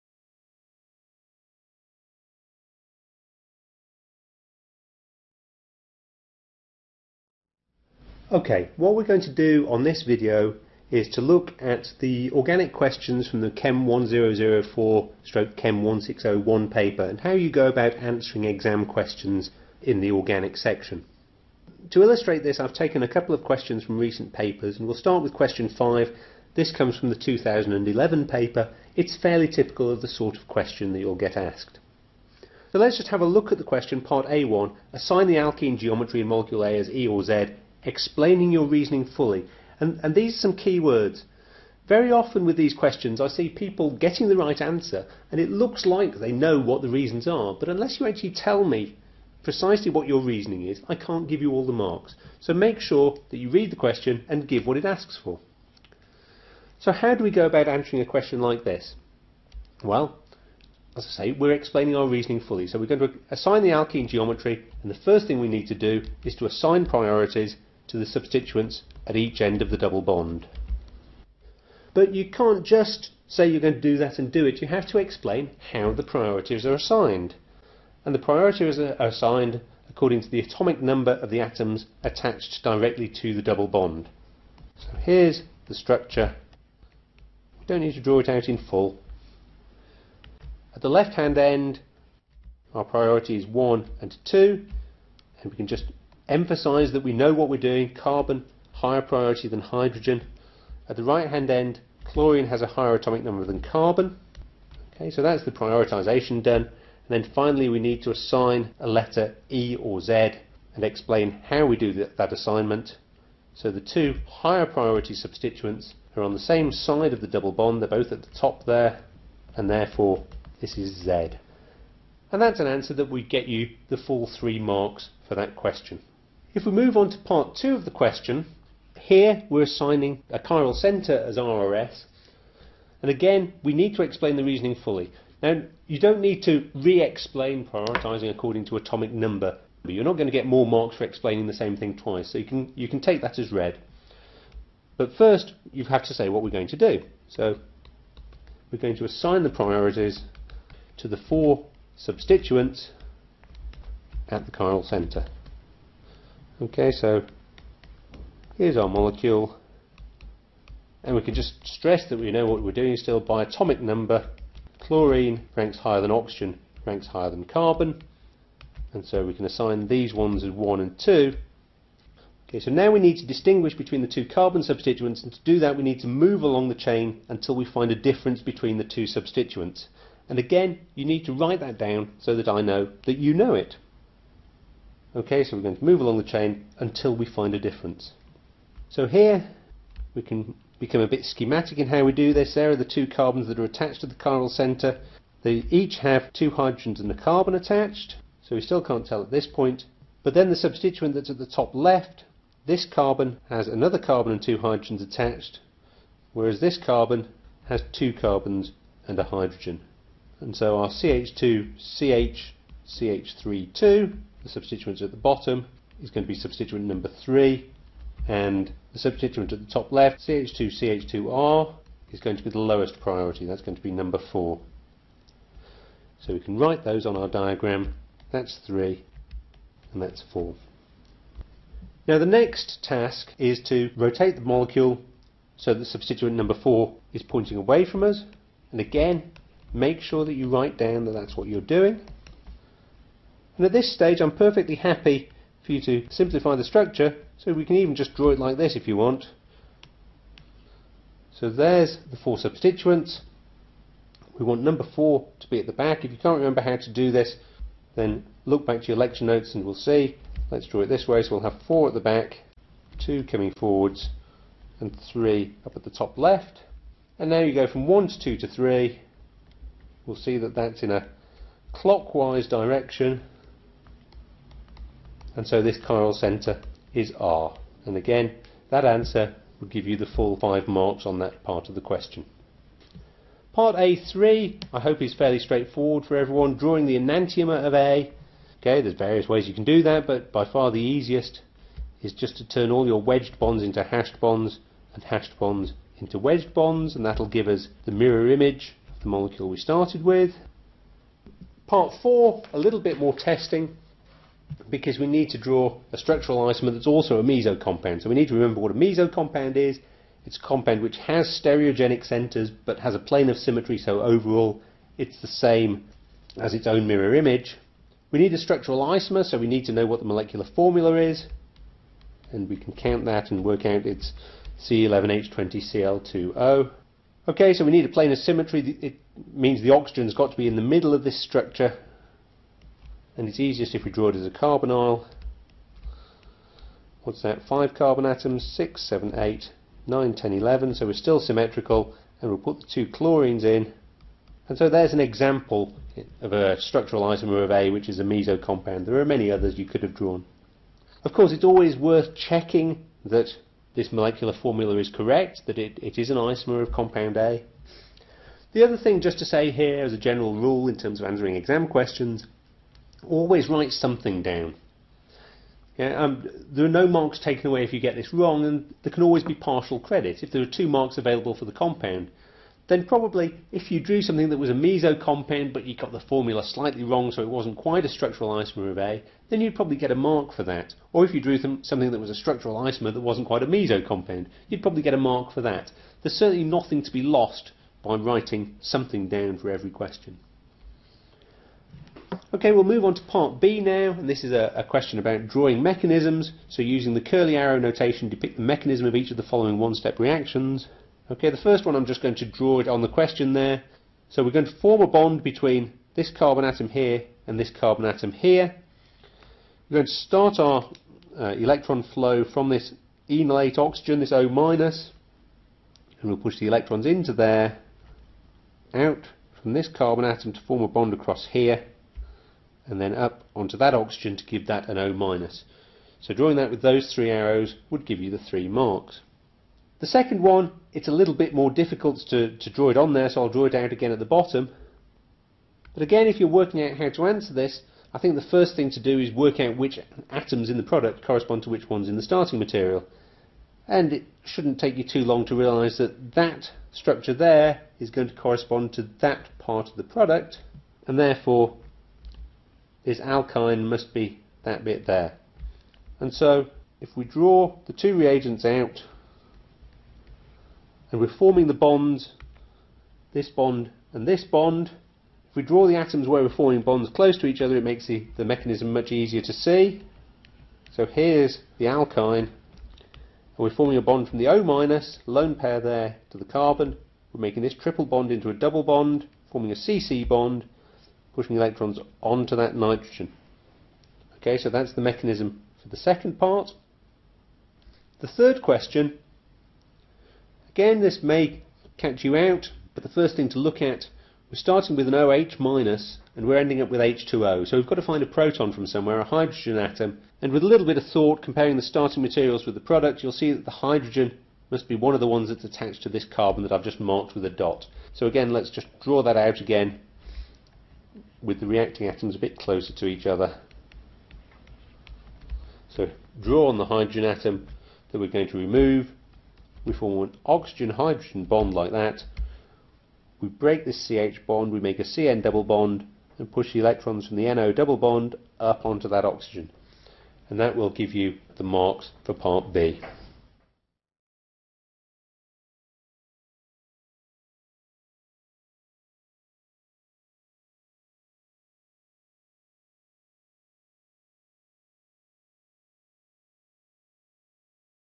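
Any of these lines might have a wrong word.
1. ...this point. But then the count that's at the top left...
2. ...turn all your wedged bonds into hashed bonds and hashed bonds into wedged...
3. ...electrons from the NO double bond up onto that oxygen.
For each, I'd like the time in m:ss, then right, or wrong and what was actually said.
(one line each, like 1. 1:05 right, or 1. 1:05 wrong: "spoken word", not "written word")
1. 3:19 wrong: "substituent", not "count"
2. 4:52 right
3. 8:46 right.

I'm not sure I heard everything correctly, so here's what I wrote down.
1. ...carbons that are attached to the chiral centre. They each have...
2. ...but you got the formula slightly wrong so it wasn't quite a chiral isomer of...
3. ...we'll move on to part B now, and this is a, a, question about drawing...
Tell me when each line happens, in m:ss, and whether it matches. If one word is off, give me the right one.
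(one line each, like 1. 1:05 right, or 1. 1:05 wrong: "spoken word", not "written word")
1. 3:13 right
2. 6:15 wrong: "structural", not "chiral"
3. 6:32 right.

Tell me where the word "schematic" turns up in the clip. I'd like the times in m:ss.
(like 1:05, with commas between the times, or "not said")
3:11.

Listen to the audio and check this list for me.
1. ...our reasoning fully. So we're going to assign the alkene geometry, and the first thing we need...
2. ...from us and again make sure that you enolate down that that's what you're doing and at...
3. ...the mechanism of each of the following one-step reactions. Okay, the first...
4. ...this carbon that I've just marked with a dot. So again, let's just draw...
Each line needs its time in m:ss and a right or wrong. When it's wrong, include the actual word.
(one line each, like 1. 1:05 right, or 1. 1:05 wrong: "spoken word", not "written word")
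1. 1:01 right
2. 3:57 wrong: "write", not "enolate"
3. 6:38 right
4. 8:25 right.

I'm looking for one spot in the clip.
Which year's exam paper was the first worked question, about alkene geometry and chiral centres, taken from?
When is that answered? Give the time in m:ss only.
0:27.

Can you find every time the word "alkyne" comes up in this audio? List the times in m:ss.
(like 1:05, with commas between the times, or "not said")
7:32, 7:51.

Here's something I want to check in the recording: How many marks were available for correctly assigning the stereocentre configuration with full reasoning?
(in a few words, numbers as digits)
5.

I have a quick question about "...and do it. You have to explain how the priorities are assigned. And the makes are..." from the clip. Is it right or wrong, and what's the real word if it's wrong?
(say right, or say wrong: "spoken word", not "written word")
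wrong: "priorities", not "makes".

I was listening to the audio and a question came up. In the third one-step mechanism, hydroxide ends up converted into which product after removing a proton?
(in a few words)
H2O.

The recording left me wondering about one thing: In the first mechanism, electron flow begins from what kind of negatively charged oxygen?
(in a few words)
Enolate oxygen.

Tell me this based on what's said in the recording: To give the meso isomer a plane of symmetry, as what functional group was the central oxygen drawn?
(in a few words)
A carbonyl.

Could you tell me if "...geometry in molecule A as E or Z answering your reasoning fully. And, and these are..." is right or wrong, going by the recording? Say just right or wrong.
wrong.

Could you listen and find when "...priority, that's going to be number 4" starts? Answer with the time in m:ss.
3:42.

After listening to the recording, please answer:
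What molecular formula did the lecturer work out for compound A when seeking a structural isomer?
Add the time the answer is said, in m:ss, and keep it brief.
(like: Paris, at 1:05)
C11H20Cl2O, at 5:24.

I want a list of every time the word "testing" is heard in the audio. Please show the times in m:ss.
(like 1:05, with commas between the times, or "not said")
5:03.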